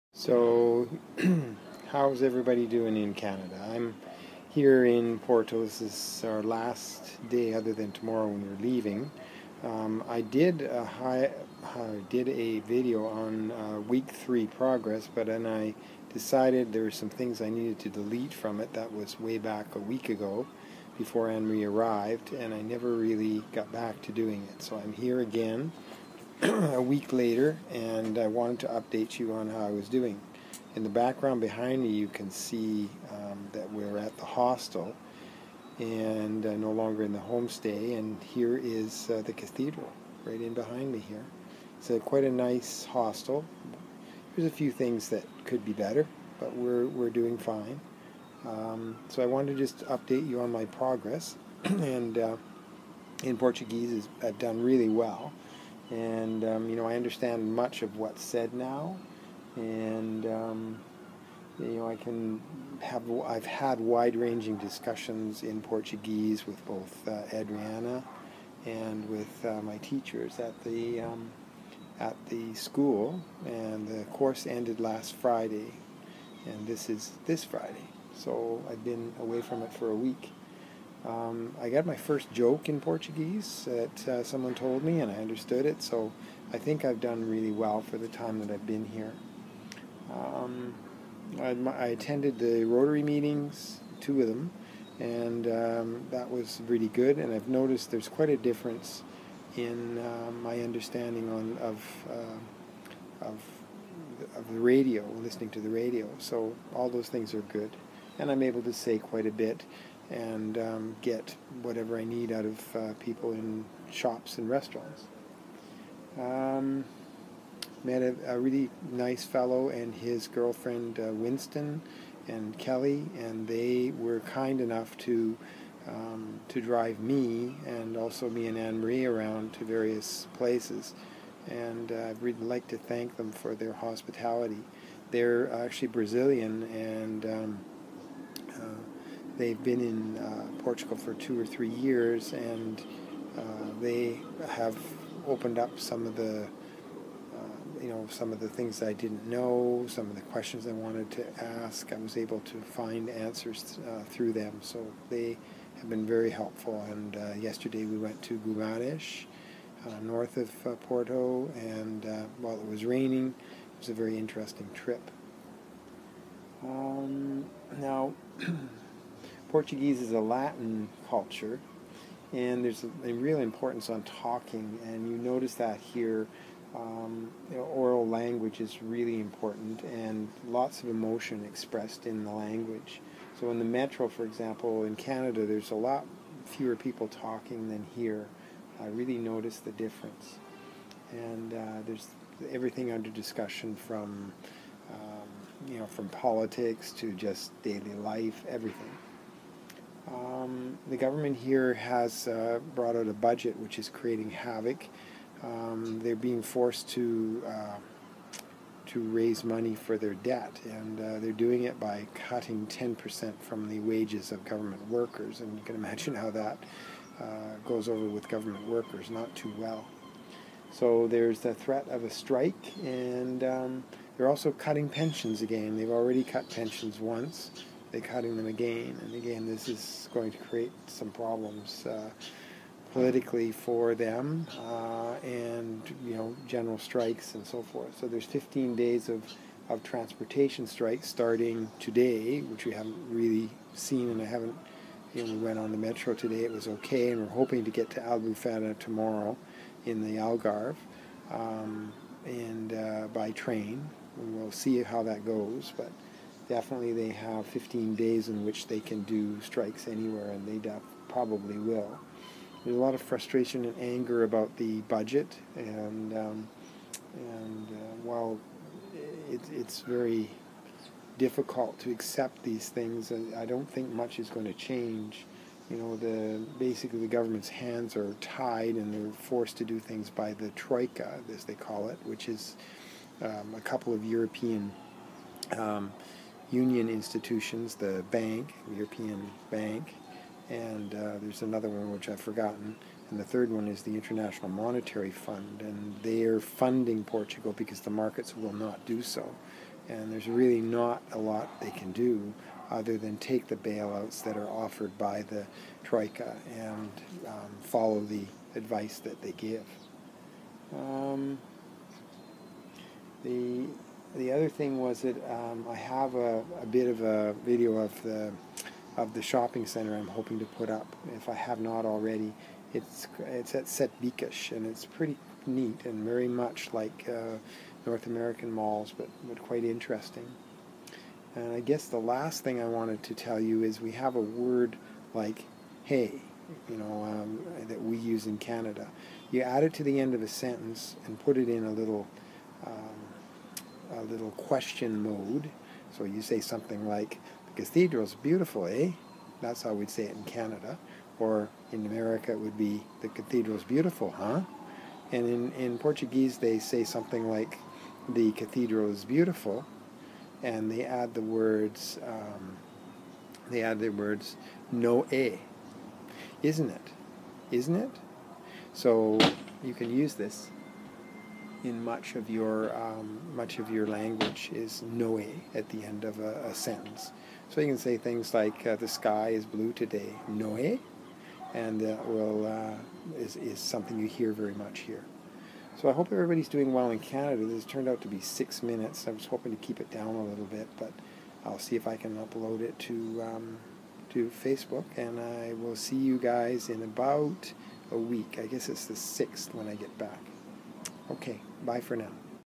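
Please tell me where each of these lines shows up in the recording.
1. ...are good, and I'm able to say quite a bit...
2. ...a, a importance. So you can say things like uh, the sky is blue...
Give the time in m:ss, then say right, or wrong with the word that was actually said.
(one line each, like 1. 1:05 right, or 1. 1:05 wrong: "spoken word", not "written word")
1. 1:47 right
2. 6:16 wrong: "sentence", not "importance".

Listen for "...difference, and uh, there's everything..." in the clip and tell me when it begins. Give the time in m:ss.
3:09.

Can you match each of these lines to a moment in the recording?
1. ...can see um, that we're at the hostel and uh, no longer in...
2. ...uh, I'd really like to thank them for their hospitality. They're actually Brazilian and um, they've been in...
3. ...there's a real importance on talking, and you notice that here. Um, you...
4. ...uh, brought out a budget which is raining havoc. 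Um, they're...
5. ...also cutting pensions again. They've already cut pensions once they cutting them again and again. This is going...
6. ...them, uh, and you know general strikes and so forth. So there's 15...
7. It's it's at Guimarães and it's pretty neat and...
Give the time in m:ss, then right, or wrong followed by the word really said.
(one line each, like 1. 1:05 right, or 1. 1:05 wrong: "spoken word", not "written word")
1. 0:32 right
2. 2:11 right
3. 2:52 right
4. 3:22 wrong: "creating", not "raining"
5. 3:44 right
6. 3:53 right
7. 5:22 wrong: "Setbikish", not "Guimarães".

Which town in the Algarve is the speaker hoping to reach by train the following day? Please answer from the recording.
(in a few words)
Albufeira.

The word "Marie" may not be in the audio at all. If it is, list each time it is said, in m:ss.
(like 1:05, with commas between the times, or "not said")
0:21, 2:08.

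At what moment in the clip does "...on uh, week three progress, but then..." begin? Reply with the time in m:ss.
0:13.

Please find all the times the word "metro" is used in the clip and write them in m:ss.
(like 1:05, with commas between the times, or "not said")
3:03, 4:05.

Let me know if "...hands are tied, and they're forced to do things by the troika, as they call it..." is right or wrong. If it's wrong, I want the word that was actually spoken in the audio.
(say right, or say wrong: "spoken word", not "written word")
right.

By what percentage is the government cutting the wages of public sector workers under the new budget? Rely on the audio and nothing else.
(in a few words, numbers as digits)
10%.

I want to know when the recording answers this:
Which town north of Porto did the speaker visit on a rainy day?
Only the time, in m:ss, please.
2:38.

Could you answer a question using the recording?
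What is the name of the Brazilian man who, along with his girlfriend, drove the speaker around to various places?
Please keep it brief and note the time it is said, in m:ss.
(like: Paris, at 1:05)
Winston, at 2:01.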